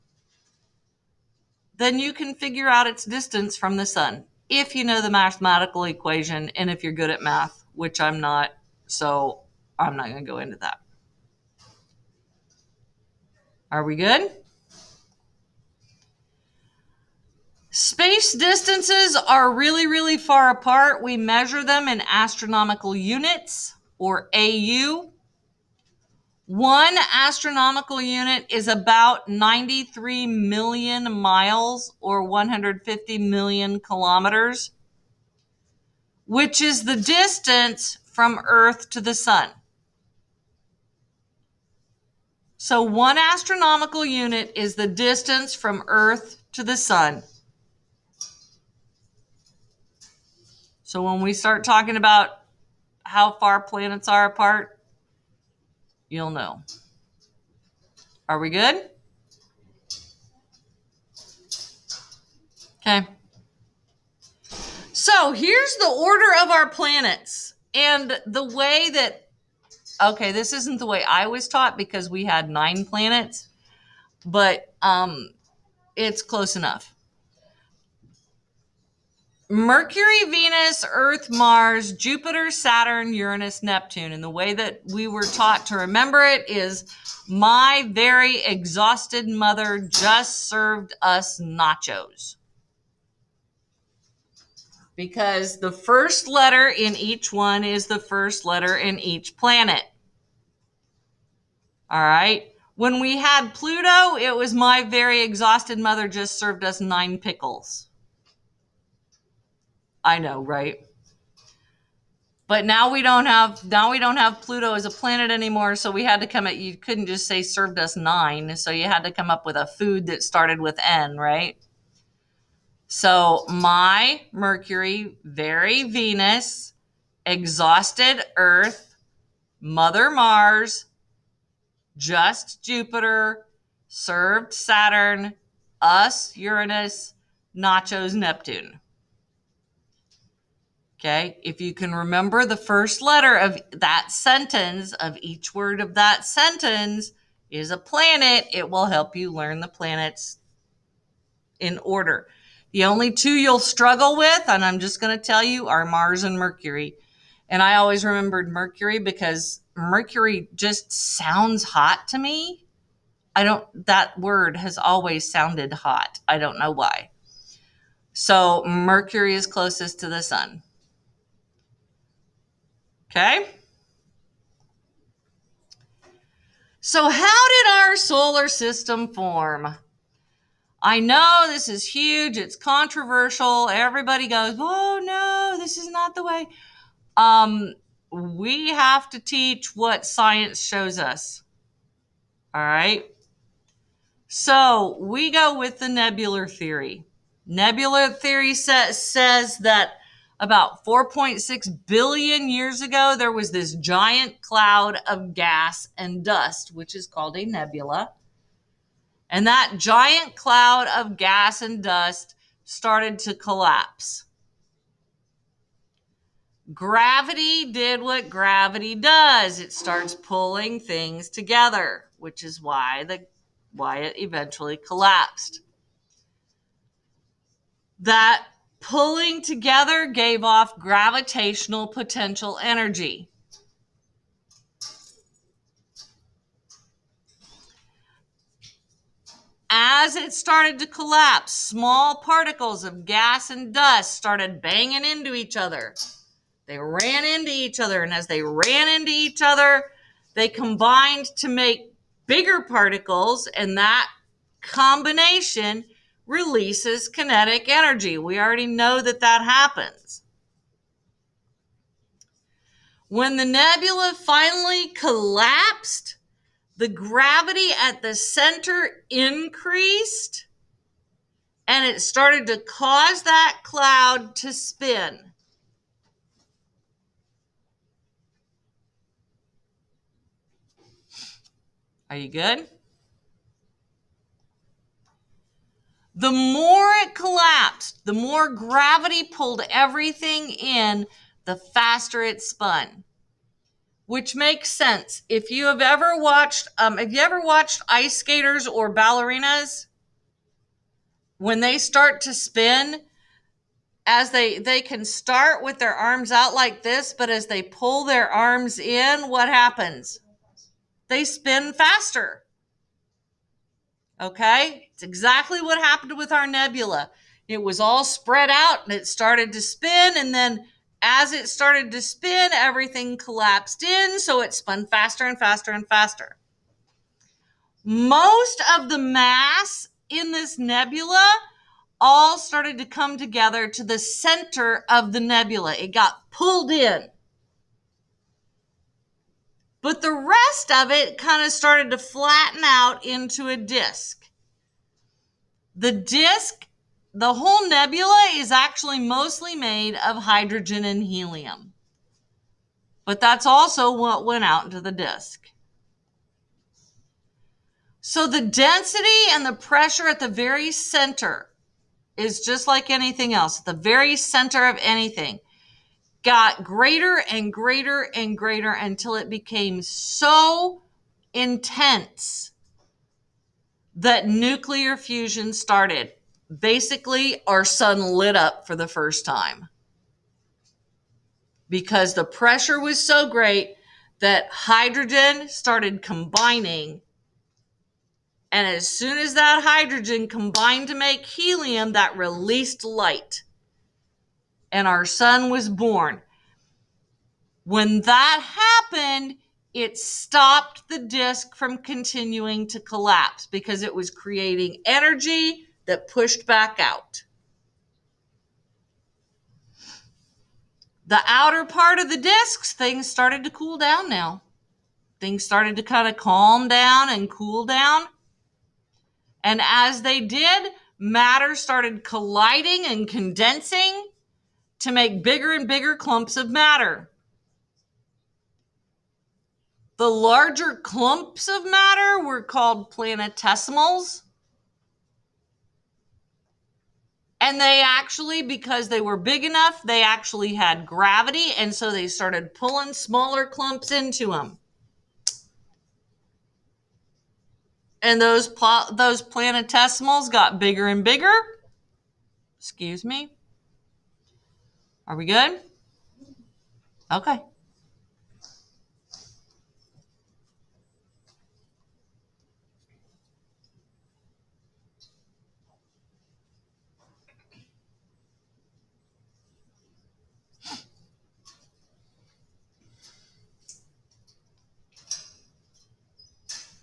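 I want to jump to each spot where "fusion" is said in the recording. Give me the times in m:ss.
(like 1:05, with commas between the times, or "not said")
6:14.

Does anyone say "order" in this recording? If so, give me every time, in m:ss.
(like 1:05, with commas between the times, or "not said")
1:05, 2:31.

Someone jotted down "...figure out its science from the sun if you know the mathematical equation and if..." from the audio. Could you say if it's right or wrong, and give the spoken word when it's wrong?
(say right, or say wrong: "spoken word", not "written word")
wrong: "distance", not "science".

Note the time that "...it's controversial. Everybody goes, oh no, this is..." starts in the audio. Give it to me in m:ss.
3:02.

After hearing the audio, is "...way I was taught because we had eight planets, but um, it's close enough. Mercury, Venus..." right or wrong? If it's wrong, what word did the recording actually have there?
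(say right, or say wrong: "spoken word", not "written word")
wrong: "nine", not "eight".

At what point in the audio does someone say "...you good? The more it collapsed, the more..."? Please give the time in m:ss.
4:42.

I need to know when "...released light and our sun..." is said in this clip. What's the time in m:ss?
6:32.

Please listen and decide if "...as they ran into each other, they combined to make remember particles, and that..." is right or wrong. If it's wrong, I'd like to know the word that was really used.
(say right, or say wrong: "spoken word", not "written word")
wrong: "bigger", not "remember".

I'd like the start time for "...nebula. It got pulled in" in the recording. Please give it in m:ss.
5:35.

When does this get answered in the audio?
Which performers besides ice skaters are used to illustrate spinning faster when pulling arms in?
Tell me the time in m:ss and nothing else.
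4:58.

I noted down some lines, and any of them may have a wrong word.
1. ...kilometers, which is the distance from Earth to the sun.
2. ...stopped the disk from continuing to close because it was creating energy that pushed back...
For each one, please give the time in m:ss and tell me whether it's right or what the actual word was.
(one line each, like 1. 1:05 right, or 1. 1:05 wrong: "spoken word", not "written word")
1. 0:33 right
2. 6:39 wrong: "collapse", not "close".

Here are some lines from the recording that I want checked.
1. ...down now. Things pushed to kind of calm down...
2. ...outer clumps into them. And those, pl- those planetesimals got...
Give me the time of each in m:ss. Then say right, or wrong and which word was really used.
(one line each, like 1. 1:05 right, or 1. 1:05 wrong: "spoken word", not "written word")
1. 6:53 wrong: "started", not "pushed"
2. 7:22 wrong: "smaller", not "outer".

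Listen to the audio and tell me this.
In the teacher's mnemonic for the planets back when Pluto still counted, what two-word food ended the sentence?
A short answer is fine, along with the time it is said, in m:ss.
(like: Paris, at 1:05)
nine pickles, at 1:46.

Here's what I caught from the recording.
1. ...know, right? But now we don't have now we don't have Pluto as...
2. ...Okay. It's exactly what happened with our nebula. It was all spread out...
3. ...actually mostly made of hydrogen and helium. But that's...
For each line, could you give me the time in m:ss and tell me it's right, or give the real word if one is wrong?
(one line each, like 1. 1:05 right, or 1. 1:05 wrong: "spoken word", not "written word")
1. 1:50 right
2. 5:14 right
3. 5:48 right.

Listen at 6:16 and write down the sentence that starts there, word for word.
Basically, our sun lit up for the first time because the pressure was so great that hydrogen started combining.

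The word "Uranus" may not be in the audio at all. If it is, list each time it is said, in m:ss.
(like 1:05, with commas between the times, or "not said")
1:23, 2:16.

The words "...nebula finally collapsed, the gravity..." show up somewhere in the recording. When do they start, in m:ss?
4:23.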